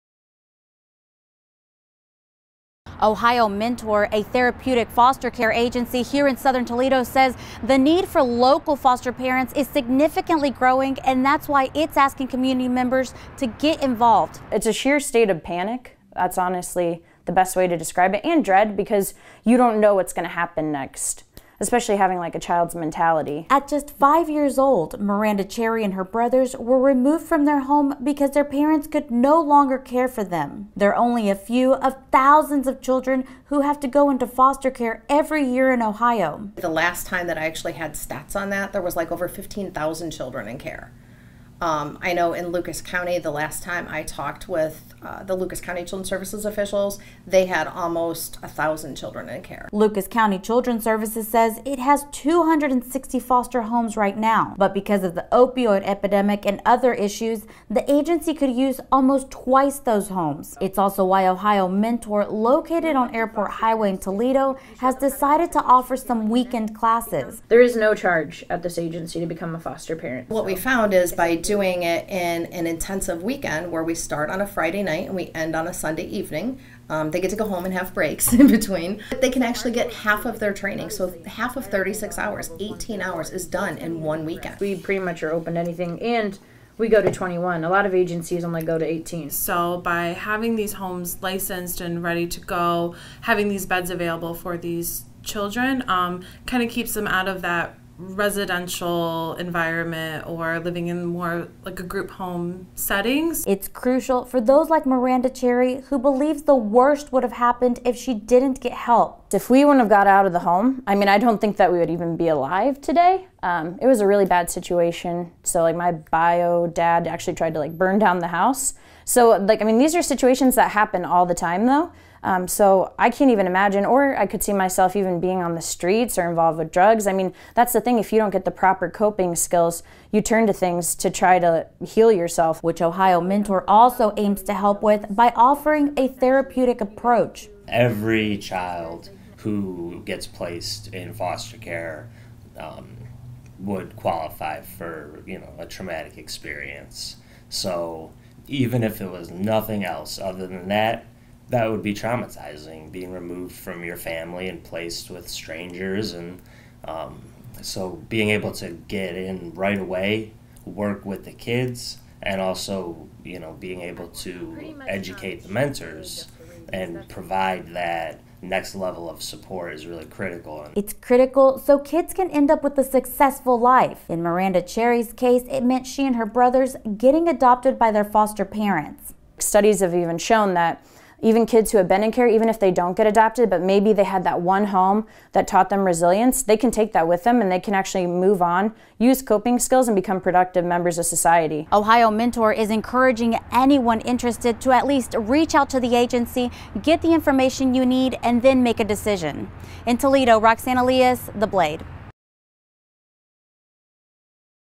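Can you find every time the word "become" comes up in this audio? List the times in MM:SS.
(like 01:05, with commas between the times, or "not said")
01:09, 03:09.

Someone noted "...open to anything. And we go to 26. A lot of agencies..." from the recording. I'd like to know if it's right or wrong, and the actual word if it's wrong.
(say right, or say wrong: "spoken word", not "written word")
wrong: "21", not "26".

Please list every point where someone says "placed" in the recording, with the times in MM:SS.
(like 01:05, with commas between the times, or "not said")
02:20, 02:34.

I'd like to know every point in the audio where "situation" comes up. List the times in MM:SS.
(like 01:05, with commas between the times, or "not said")
01:54, 02:00.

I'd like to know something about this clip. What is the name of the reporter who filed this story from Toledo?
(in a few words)
Roxanne Elias.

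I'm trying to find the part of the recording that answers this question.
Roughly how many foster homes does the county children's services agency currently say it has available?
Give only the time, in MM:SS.
00:52.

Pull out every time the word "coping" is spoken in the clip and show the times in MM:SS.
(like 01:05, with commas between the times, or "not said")
02:08, 03:09.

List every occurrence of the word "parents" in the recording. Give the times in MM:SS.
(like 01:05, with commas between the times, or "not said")
00:09, 00:28, 01:09, 02:58.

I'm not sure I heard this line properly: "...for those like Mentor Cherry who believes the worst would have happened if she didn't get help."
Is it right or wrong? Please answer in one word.
wrong.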